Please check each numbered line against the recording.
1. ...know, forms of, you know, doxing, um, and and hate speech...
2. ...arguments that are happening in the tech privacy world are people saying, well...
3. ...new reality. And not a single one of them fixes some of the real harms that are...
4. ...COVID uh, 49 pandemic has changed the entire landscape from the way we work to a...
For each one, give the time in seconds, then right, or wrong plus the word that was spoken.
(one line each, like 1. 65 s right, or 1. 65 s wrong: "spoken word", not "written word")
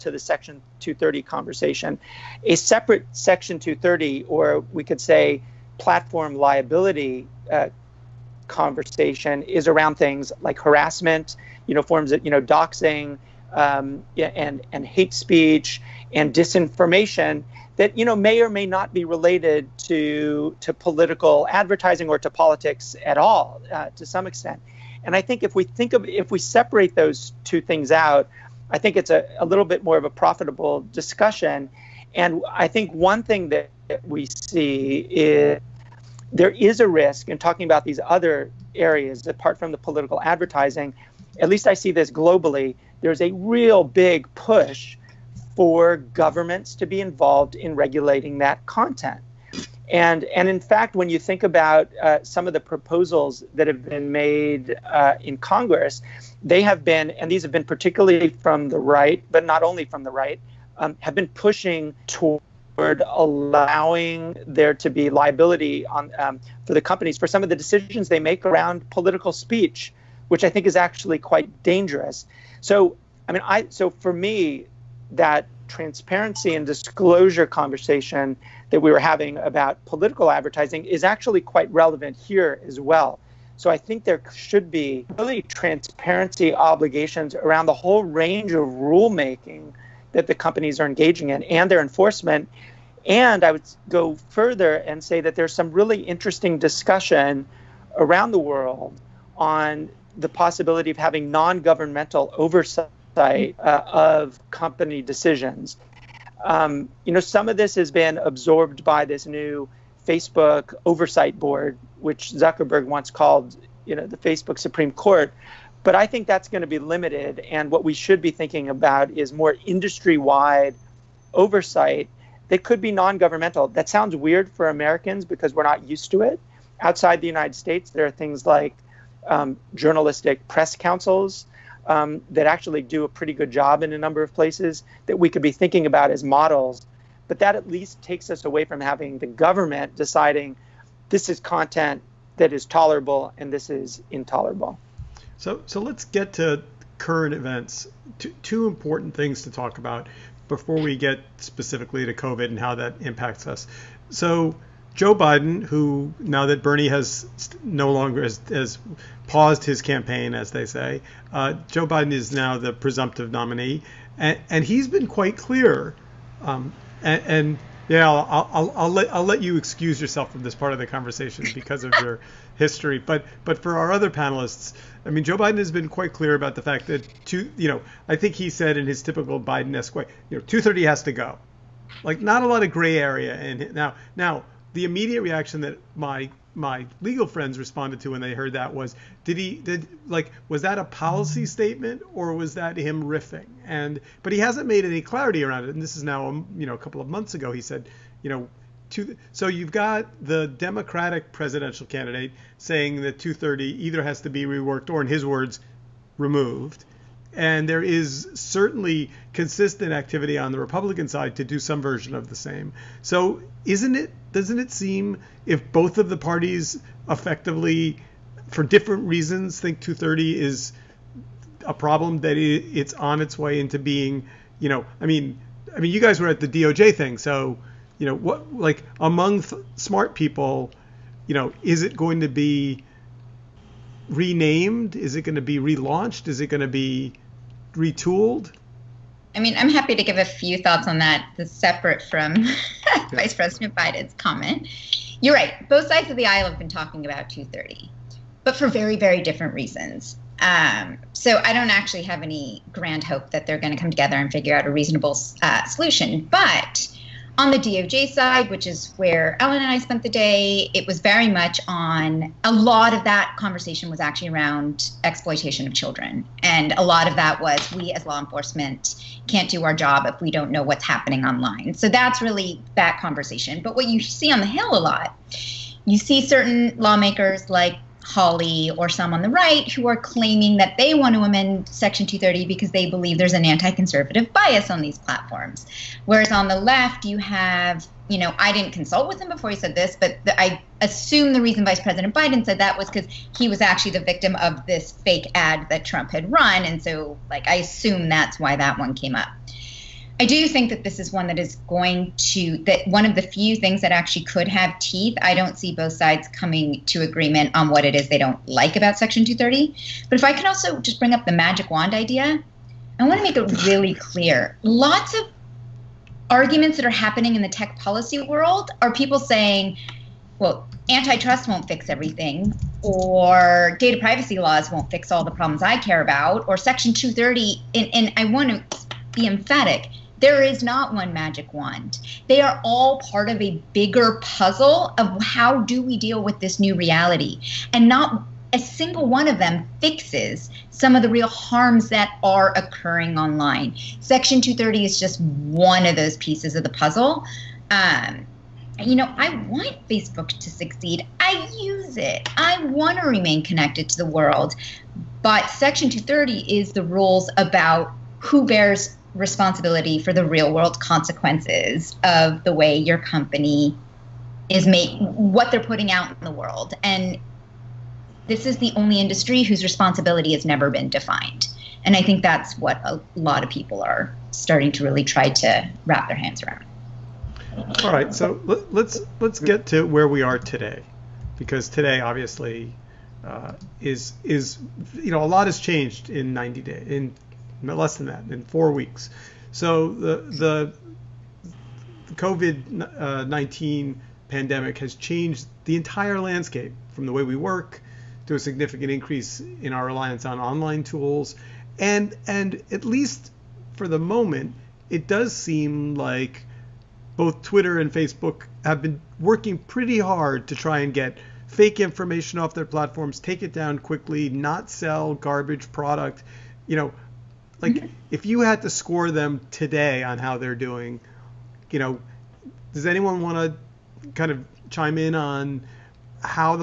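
1. 11 s right
2. 316 s wrong: "policy", not "privacy"
3. 336 s right
4. 392 s wrong: "19", not "49".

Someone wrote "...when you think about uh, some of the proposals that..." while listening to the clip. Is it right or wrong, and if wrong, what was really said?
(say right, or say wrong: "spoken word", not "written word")
right.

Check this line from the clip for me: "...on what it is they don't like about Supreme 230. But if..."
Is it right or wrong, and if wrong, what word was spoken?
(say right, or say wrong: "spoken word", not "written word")
wrong: "Section", not "Supreme".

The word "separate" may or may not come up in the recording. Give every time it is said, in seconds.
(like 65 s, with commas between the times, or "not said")
2 s, 26 s, 241 s.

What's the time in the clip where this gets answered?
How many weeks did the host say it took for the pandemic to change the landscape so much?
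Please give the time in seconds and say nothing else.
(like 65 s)
388 s.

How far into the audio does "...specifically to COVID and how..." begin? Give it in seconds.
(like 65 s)
151 s.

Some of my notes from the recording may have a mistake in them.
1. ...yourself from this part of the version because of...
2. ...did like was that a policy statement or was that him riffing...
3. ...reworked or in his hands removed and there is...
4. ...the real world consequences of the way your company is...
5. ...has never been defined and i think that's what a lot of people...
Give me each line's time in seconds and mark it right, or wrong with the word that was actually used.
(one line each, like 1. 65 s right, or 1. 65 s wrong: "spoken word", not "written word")
1. 170 s wrong: "conversation", not "version"
2. 189 s right
3. 204 s wrong: "words", not "hands"
4. 360 s right
5. 370 s right.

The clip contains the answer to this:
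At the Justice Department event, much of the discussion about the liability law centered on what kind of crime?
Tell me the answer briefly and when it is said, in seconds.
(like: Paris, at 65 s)
exploitation of children, at 265 s.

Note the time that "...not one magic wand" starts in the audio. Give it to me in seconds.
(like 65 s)
330 s.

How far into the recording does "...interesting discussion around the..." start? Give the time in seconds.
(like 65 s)
95 s.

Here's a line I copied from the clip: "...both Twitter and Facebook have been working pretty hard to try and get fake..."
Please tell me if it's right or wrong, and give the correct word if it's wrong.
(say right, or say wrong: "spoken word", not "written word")
right.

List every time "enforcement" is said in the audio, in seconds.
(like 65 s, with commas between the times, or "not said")
91 s, 268 s.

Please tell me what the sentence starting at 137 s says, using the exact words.
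But that at least takes us away from having the government deciding this is content that is tolerable and this is intolerable.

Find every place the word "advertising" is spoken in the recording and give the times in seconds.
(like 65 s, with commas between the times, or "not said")
21 s, 40 s, 80 s.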